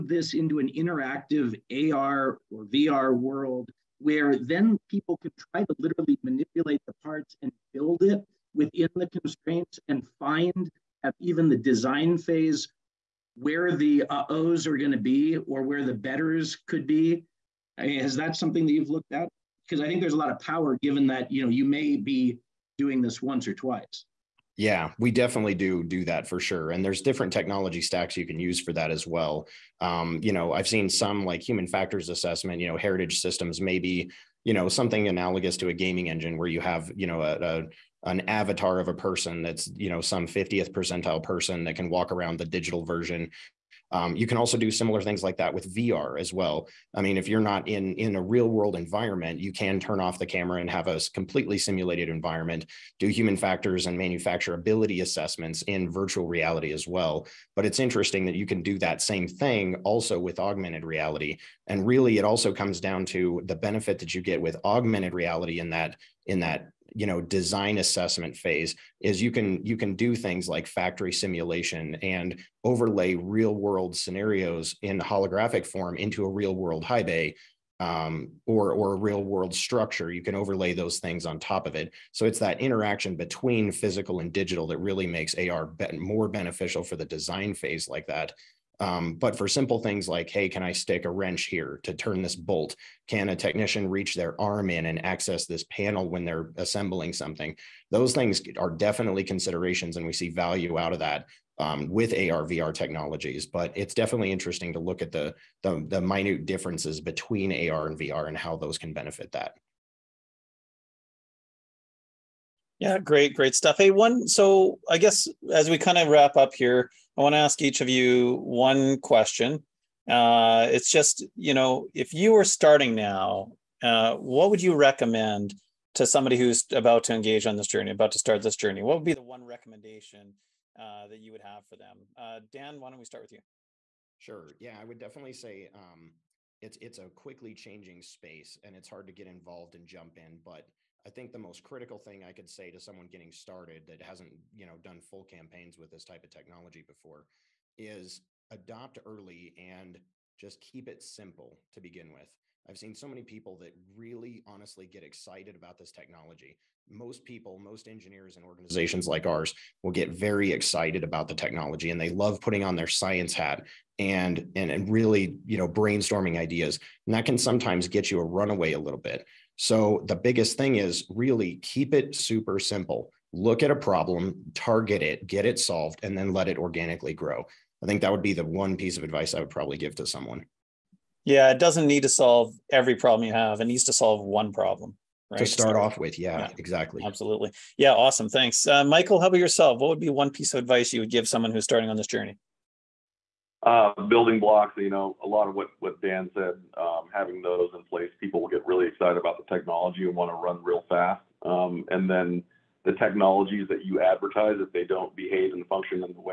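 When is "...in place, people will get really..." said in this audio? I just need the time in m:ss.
3:17.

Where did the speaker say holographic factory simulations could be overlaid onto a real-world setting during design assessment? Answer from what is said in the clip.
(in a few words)
high bay.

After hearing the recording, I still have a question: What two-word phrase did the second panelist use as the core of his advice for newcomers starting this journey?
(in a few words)
building blocks.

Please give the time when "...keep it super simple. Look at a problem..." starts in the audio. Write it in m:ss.
2:51.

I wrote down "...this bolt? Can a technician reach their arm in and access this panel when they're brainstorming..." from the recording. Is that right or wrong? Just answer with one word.
wrong.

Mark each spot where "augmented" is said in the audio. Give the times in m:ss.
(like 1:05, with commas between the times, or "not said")
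1:00, 1:04.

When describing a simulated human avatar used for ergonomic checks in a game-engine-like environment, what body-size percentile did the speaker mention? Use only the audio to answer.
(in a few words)
50th percentile.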